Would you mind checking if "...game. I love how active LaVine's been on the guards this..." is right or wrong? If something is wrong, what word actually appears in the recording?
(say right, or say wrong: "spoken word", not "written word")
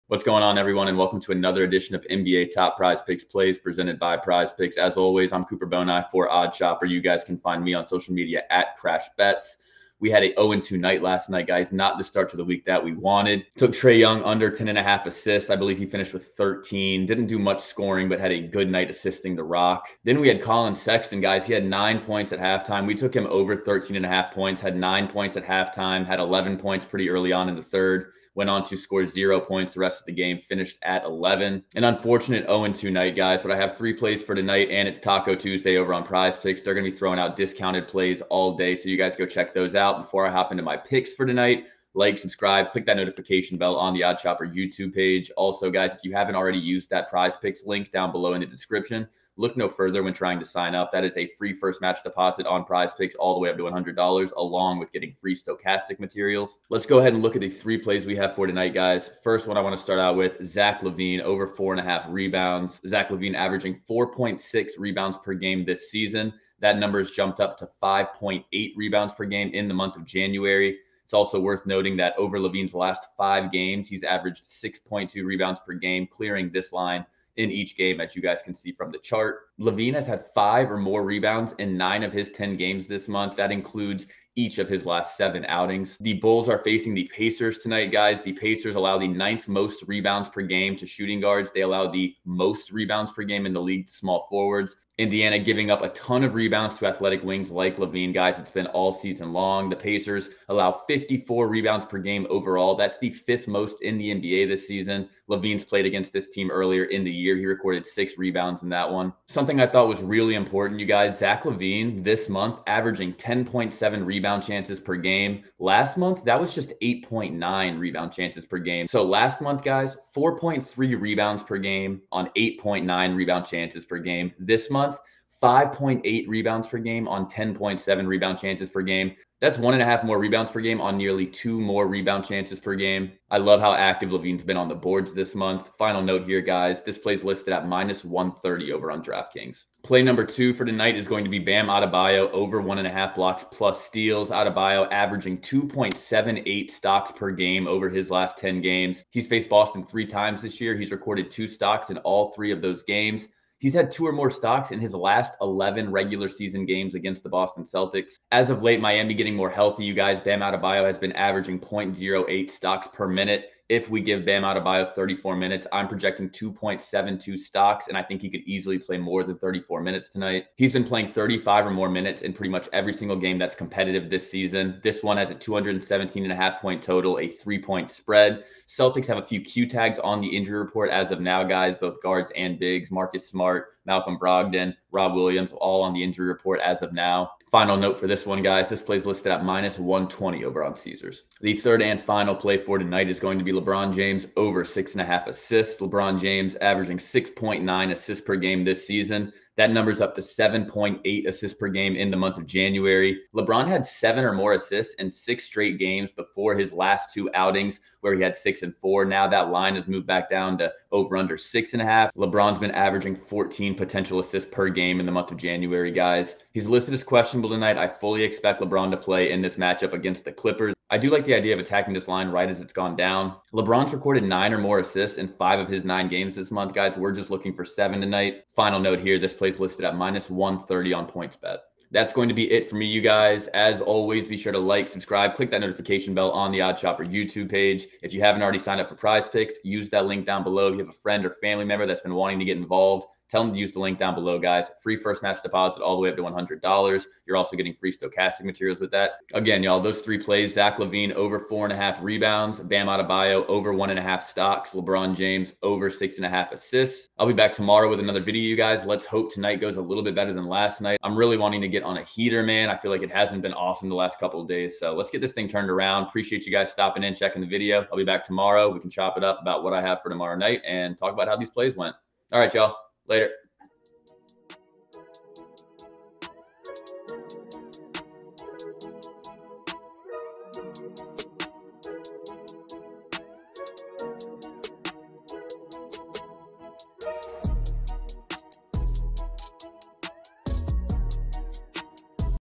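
wrong: "boards", not "guards".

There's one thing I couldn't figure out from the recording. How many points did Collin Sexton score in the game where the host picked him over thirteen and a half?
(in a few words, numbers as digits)
11.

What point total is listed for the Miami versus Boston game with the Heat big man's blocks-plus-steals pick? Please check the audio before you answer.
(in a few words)
217.5.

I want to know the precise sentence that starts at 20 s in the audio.
Then we had Collin Sexton, guys.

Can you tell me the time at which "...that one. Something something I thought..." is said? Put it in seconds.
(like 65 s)
108 s.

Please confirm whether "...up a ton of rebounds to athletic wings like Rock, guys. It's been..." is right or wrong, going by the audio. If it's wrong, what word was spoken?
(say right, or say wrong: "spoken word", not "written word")
wrong: "LaVine", not "Rock".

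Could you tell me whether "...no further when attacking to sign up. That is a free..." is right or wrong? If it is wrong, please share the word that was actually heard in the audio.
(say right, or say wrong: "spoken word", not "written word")
wrong: "trying", not "attacking".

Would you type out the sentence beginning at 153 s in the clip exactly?
He's had two or more stocks in his last 11 regular season games against the Boston Celtics.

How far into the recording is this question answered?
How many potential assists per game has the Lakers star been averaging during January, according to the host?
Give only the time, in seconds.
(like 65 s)
213 s.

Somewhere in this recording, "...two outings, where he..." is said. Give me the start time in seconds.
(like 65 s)
207 s.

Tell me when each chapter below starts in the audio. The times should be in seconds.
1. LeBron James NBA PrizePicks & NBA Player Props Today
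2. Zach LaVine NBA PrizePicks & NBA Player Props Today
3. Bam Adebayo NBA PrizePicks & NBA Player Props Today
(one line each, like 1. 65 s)
1. 191 s
2. 57 s
3. 139 s.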